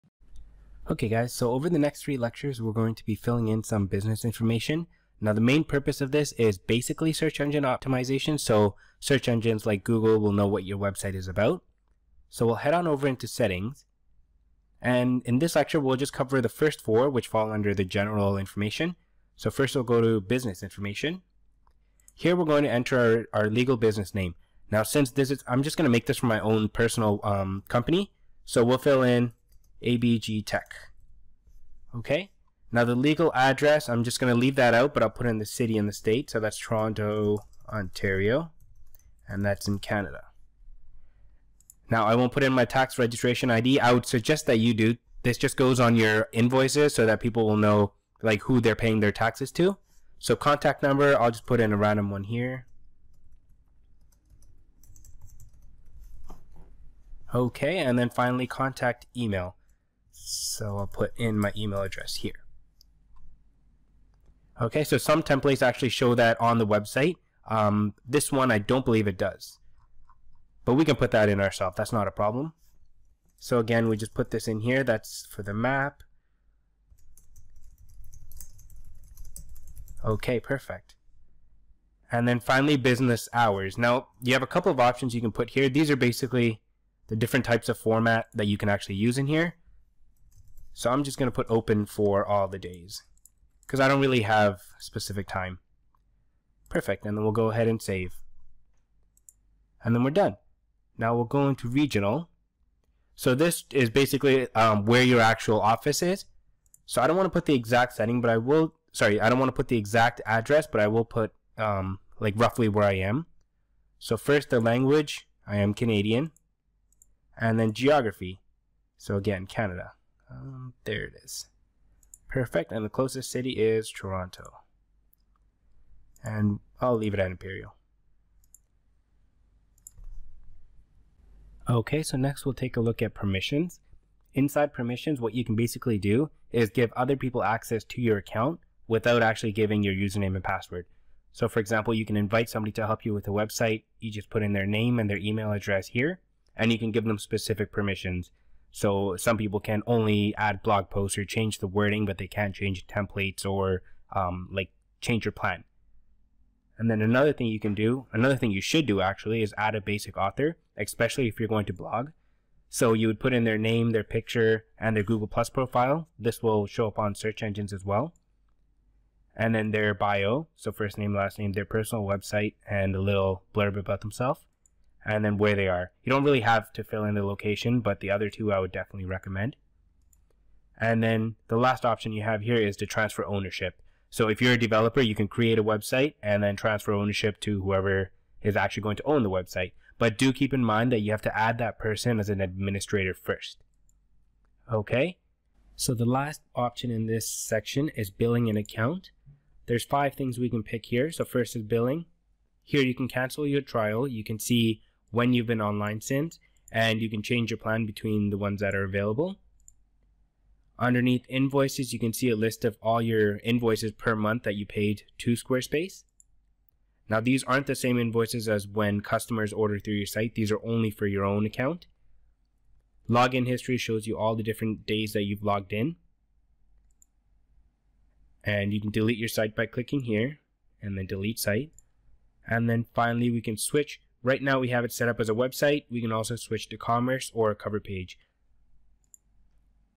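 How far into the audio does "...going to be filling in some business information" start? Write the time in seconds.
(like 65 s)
2 s.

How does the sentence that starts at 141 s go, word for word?
So for example, you can invite somebody to help you with a website.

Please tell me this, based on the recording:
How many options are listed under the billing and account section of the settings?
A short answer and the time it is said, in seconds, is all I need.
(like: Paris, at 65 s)
5, at 199 s.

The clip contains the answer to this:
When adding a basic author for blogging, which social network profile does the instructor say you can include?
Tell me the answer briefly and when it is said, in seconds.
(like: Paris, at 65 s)
Google Plus, at 165 s.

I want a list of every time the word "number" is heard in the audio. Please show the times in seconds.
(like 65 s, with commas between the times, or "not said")
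50 s.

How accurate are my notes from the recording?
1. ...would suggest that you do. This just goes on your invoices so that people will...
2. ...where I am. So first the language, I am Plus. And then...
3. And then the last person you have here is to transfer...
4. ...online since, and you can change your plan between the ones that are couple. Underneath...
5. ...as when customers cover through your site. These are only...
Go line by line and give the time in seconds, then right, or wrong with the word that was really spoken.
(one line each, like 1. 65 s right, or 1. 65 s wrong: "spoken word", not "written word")
1. 43 s right
2. 112 s wrong: "Canadian", not "Plus"
3. 180 s wrong: "option", not "person"
4. 205 s wrong: "available", not "couple"
5. 218 s wrong: "order", not "cover".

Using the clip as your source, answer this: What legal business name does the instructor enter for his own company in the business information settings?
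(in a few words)
ABG Tech.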